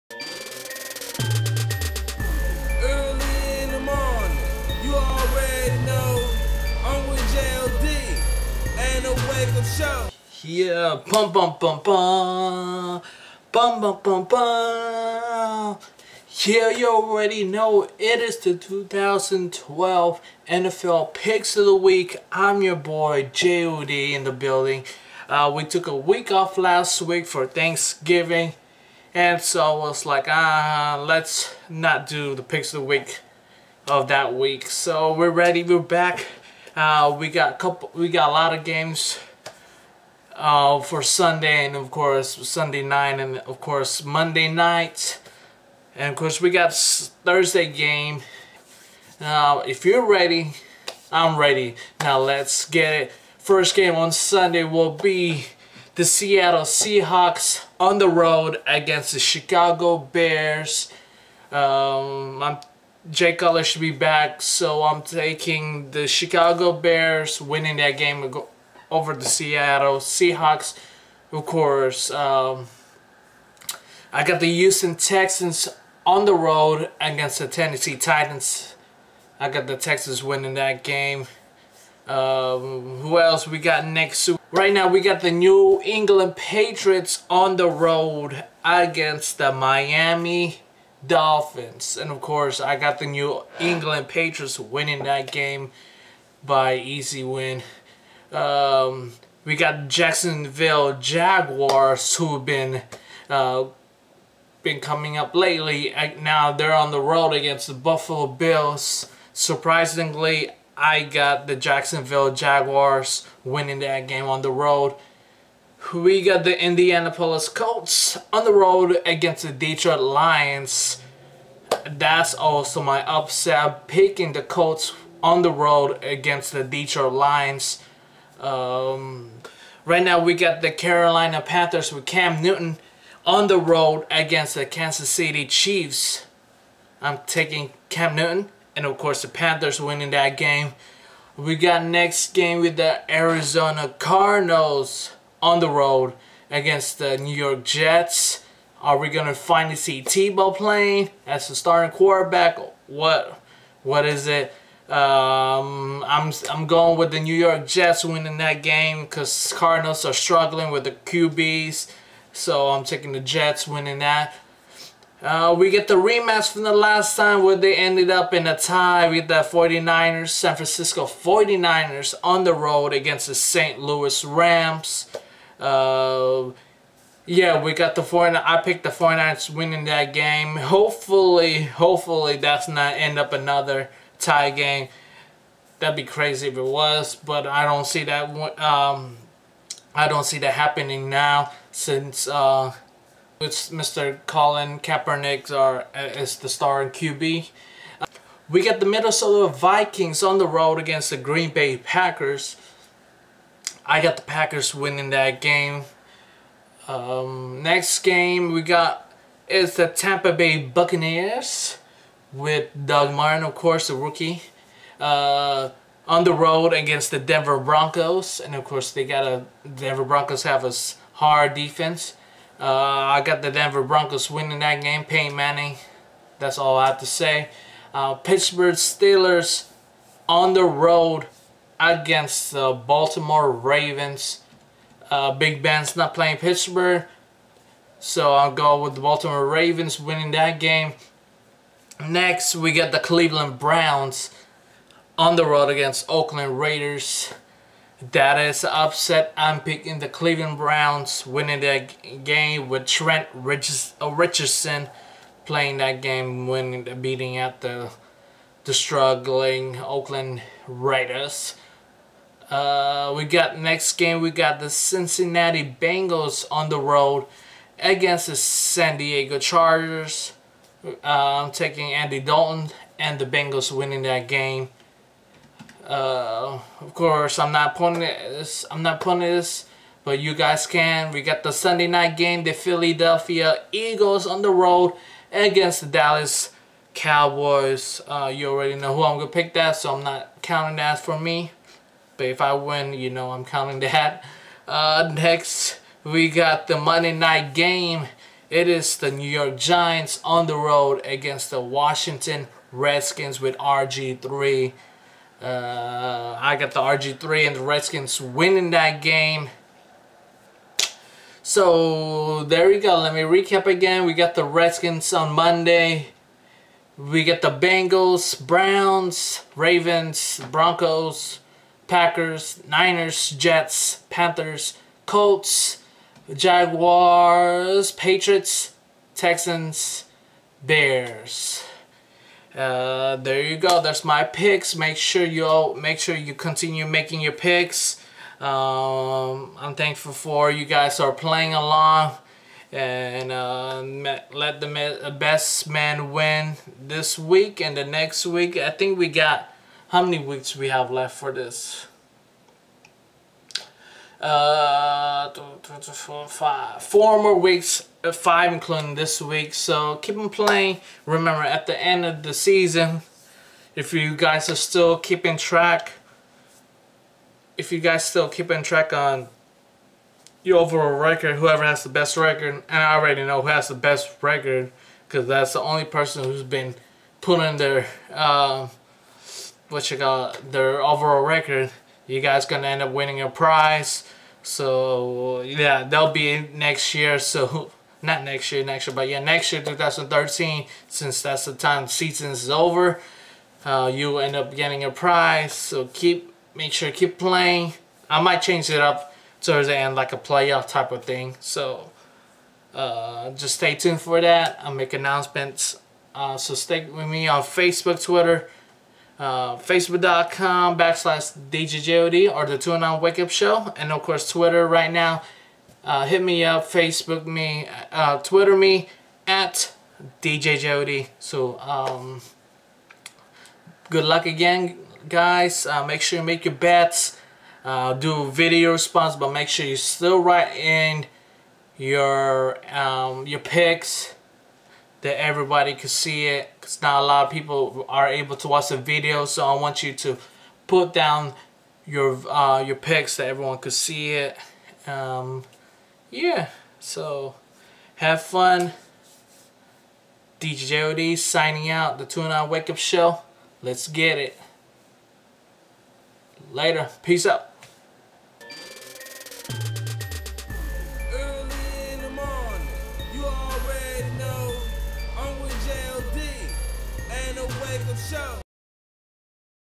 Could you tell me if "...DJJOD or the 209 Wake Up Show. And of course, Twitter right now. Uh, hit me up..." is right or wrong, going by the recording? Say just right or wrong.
right.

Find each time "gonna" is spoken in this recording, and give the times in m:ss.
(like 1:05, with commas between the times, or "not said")
2:29, 4:49, 6:22.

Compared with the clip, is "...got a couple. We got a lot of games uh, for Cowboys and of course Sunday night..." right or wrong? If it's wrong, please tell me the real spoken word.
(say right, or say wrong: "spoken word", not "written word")
wrong: "Sunday", not "Cowboys".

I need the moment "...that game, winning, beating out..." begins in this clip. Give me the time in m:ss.
4:15.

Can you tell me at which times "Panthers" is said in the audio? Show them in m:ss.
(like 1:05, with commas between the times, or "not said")
2:11, 2:19, 5:24.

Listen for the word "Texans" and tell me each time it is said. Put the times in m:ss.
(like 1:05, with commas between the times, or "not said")
1:14, 1:19, 5:29.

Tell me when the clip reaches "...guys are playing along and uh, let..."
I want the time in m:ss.
5:40.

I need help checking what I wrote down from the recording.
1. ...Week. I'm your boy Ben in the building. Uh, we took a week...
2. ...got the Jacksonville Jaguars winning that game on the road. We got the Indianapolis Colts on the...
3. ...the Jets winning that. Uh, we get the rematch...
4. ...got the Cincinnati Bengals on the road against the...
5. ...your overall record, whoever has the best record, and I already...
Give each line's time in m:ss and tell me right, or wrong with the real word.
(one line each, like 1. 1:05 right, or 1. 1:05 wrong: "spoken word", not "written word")
1. 0:21 wrong: "Jody", not "Ben"
2. 1:51 right
3. 2:43 right
4. 4:24 right
5. 6:10 right.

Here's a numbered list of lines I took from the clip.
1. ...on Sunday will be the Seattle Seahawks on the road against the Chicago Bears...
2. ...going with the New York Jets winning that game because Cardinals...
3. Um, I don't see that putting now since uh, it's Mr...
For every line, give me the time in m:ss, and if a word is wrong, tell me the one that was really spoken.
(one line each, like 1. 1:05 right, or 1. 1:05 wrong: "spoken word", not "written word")
1. 0:53 right
2. 2:36 right
3. 3:08 wrong: "happening", not "putting".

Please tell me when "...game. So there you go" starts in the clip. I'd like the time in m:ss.
5:09.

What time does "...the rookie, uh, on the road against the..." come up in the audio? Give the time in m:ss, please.
3:33.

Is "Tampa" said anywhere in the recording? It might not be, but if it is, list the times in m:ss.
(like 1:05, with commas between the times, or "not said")
3:29.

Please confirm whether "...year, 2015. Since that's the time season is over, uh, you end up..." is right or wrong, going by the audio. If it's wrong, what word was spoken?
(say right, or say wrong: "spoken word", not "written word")
wrong: "2013", not "2015".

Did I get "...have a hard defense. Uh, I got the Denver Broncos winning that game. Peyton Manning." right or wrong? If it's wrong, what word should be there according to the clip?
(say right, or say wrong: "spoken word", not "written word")
right.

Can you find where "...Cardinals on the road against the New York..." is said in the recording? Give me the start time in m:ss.
2:23.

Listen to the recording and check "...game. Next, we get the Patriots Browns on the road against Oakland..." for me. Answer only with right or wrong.
wrong.